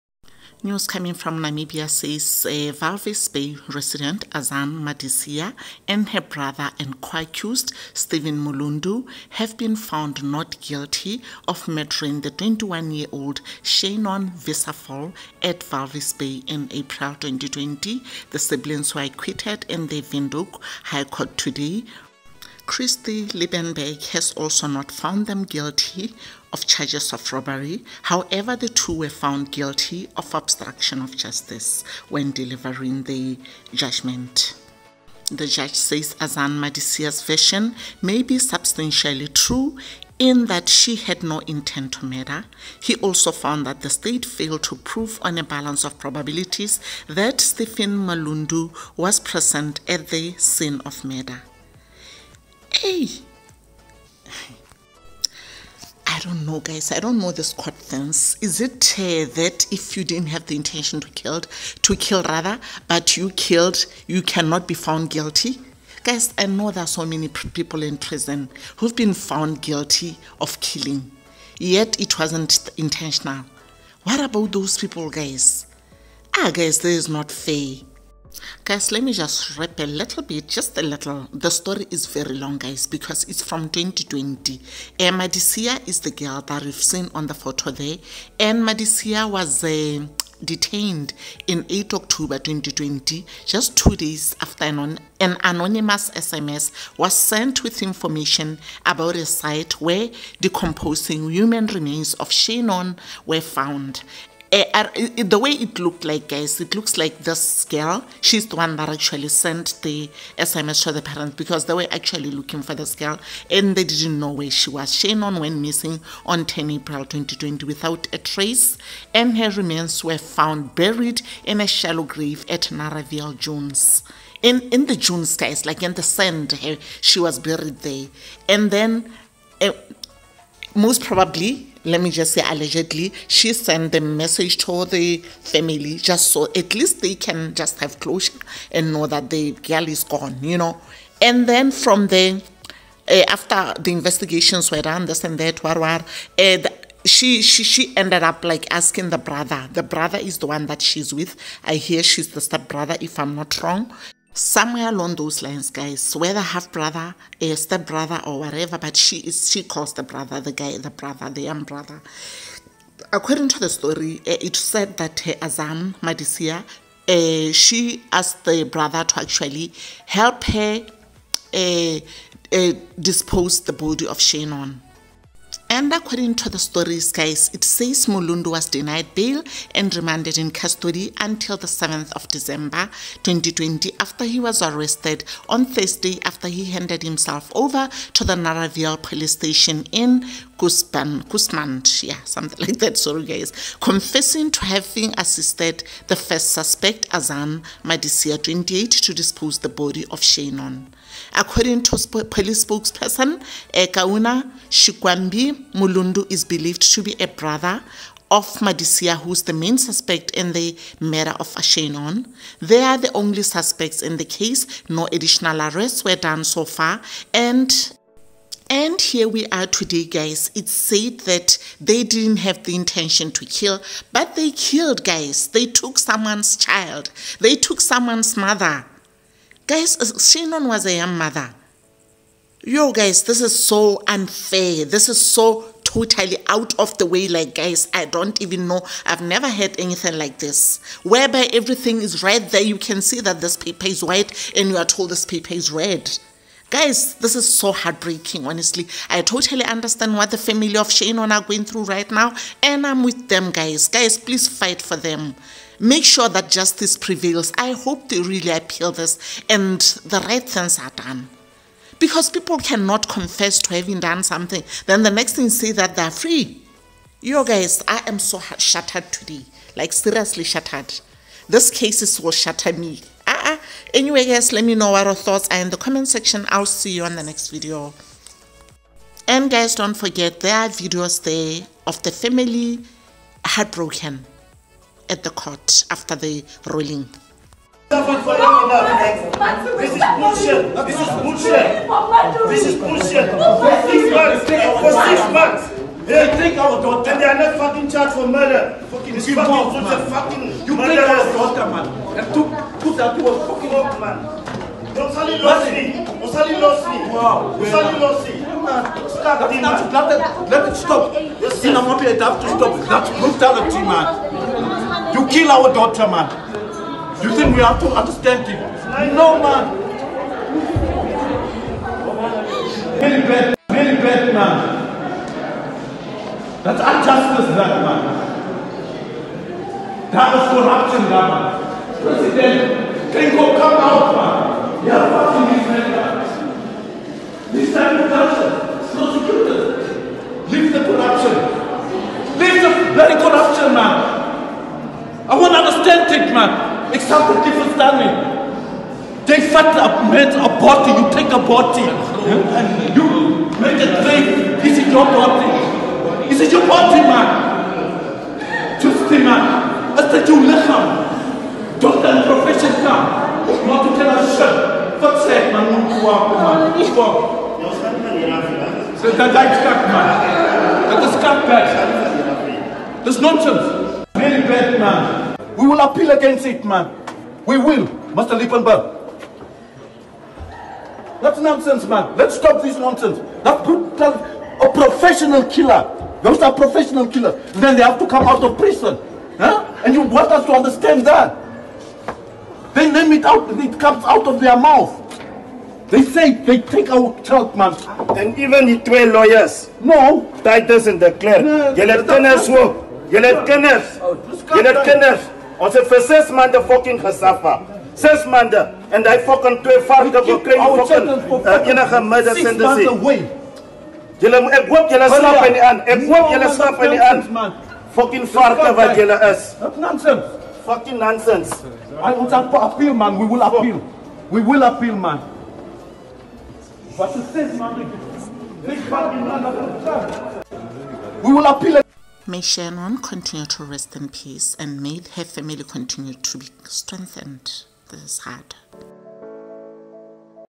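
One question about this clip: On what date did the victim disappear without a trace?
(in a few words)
10 April 2020.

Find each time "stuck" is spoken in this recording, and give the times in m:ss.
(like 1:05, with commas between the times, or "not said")
6:09.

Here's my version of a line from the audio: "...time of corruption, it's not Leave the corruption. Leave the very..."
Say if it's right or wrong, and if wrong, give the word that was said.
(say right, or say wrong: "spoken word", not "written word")
right.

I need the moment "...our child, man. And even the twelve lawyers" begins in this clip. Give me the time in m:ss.
6:36.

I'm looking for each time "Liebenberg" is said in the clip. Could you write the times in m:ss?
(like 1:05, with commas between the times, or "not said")
0:23, 6:18.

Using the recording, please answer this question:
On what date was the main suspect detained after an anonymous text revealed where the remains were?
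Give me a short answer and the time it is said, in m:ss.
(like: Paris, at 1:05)
8 October 2020, at 1:31.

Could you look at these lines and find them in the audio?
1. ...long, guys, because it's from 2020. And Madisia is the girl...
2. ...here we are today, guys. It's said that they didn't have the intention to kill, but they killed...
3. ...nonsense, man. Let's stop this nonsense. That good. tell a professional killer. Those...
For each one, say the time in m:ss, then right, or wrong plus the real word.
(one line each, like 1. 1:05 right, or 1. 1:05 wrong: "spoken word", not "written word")
1. 1:22 right
2. 3:39 right
3. 6:21 right.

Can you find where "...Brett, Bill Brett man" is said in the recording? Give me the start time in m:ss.
5:23.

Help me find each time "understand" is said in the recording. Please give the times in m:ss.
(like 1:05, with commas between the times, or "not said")
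4:09, 5:17, 5:45, 6:30.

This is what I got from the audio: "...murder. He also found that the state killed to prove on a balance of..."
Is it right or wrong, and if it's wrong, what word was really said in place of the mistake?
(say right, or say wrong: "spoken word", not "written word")
wrong: "failed", not "killed".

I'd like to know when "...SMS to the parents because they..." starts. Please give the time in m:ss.
1:50.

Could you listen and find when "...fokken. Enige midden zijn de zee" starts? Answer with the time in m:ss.
6:51.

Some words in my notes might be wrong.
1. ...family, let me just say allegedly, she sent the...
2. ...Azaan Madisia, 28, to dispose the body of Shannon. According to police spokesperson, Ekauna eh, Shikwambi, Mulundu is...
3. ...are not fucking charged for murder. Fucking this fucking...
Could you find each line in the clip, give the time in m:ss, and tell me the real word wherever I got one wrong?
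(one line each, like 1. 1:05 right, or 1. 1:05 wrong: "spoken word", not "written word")
1. 2:11 wrong: "probably", not "family"
2. 3:17 right
3. 4:57 right.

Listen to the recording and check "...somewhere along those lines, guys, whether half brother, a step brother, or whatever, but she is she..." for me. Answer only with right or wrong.
right.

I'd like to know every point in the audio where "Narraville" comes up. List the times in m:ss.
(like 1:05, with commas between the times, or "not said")
2:02, 3:08.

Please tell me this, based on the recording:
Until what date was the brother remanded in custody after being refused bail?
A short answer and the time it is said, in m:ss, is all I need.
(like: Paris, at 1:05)
7 December 2020, at 3:01.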